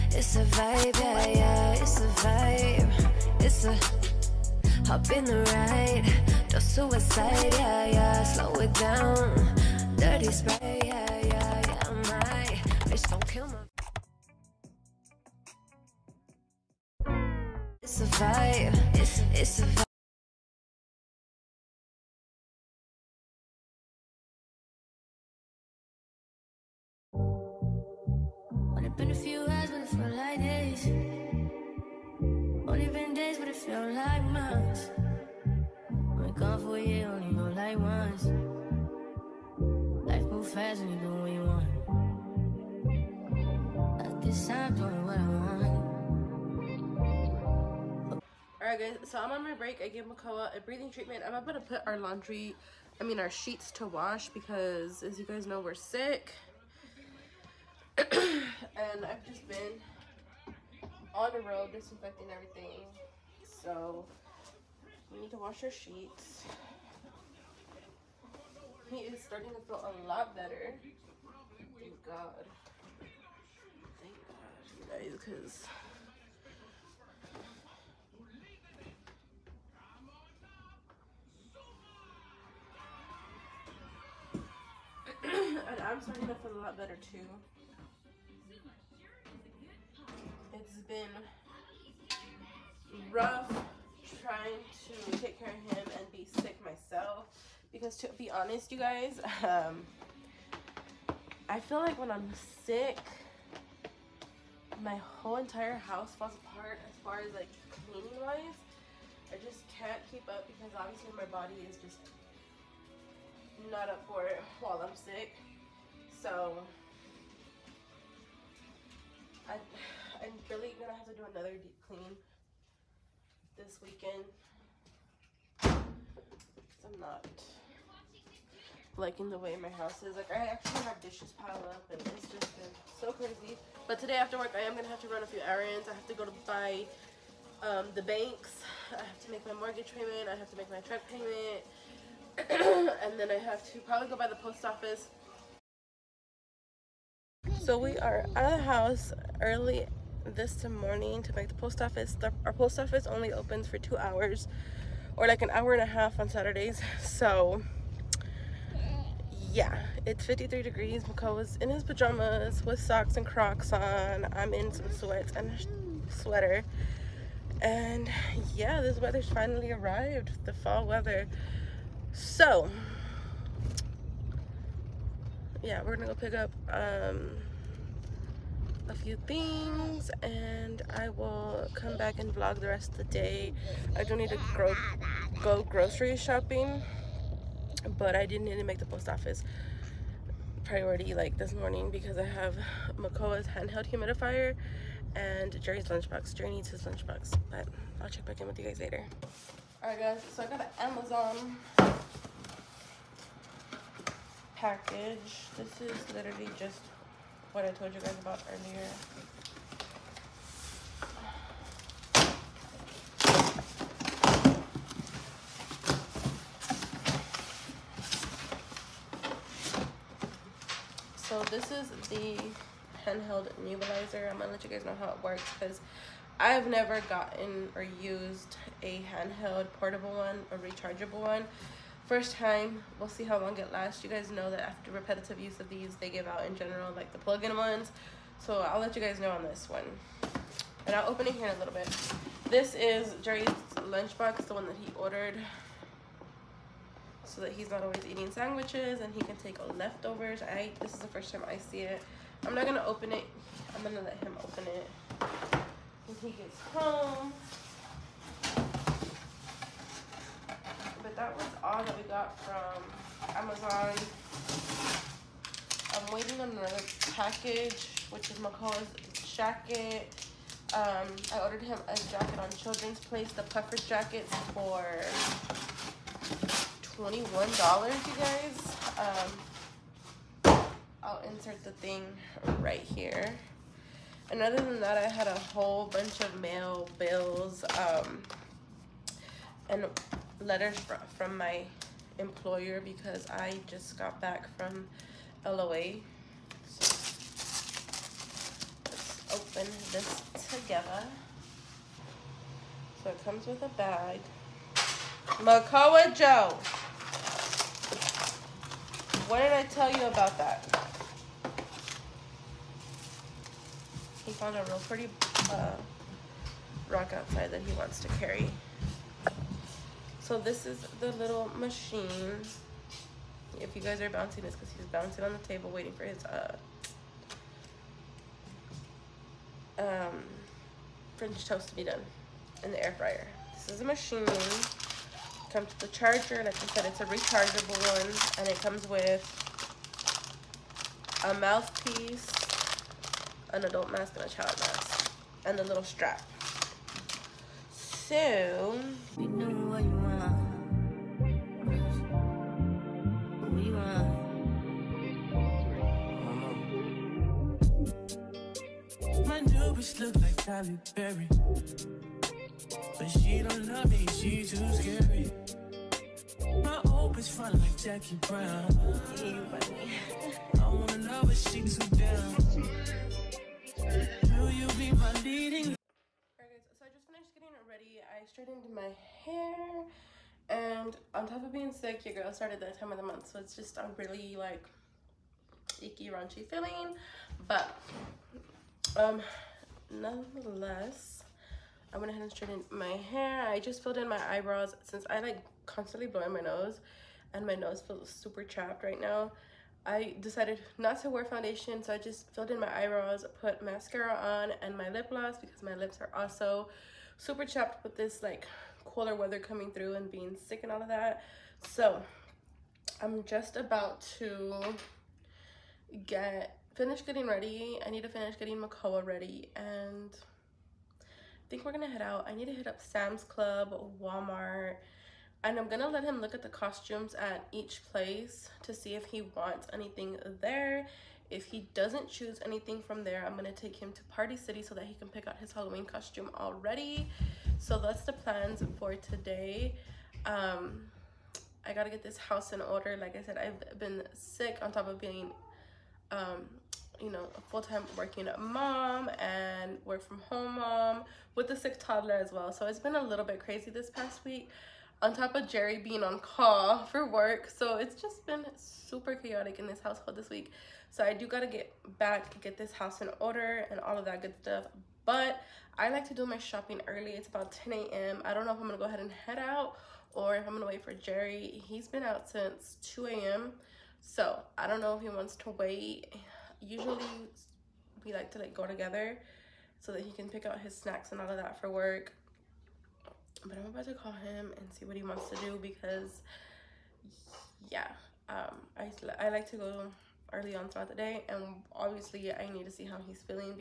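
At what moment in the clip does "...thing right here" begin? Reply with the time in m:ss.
4:41.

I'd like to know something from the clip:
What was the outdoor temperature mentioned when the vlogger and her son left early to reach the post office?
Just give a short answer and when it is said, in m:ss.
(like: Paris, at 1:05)
53 degrees, at 2:40.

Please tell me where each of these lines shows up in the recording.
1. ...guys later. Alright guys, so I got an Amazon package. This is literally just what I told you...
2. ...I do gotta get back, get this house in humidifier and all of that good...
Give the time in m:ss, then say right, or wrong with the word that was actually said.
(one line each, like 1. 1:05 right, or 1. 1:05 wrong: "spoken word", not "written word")
1. 3:18 right
2. 7:41 wrong: "order", not "humidifier".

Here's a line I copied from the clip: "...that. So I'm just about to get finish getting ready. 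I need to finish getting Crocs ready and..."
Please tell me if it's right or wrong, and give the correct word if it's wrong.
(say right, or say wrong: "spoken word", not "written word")
wrong: "Makoa", not "Crocs".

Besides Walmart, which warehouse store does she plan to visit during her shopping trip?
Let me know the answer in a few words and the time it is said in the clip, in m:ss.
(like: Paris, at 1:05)
Sam's Club, at 7:02.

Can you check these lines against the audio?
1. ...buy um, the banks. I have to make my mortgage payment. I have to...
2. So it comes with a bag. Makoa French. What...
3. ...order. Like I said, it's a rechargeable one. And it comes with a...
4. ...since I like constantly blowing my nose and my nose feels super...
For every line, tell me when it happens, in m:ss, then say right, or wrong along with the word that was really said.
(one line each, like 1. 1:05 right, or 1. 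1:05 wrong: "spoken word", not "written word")
1. 2:16 right
2. 5:03 wrong: "Joe", not "French"
3. 5:35 wrong: "charger", not "order"
4. 6:34 right.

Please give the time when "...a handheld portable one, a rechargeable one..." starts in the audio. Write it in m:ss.
3:48.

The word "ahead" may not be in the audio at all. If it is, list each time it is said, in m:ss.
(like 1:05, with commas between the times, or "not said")
6:32, 7:48.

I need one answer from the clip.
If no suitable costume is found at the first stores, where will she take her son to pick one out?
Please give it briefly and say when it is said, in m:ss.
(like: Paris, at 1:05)
Party City, at 7:14.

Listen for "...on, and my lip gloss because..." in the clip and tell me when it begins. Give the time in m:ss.
6:44.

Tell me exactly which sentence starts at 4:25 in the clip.
I'm waiting on another package, which is Makoa's jacket.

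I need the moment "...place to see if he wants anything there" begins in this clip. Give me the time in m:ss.
7:07.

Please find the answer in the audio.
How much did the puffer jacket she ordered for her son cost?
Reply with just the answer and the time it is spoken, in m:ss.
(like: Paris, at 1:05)
$21, at 4:36.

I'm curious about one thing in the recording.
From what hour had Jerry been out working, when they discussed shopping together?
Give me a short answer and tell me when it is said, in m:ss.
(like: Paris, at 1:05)
2 a.m., at 7:52.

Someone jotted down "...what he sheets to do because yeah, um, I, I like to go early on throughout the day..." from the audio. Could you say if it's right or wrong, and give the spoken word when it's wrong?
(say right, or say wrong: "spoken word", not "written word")
wrong: "wants", not "sheets".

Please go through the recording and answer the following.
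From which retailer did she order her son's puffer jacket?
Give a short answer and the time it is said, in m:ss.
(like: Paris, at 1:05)
Children's Place, at 4:32.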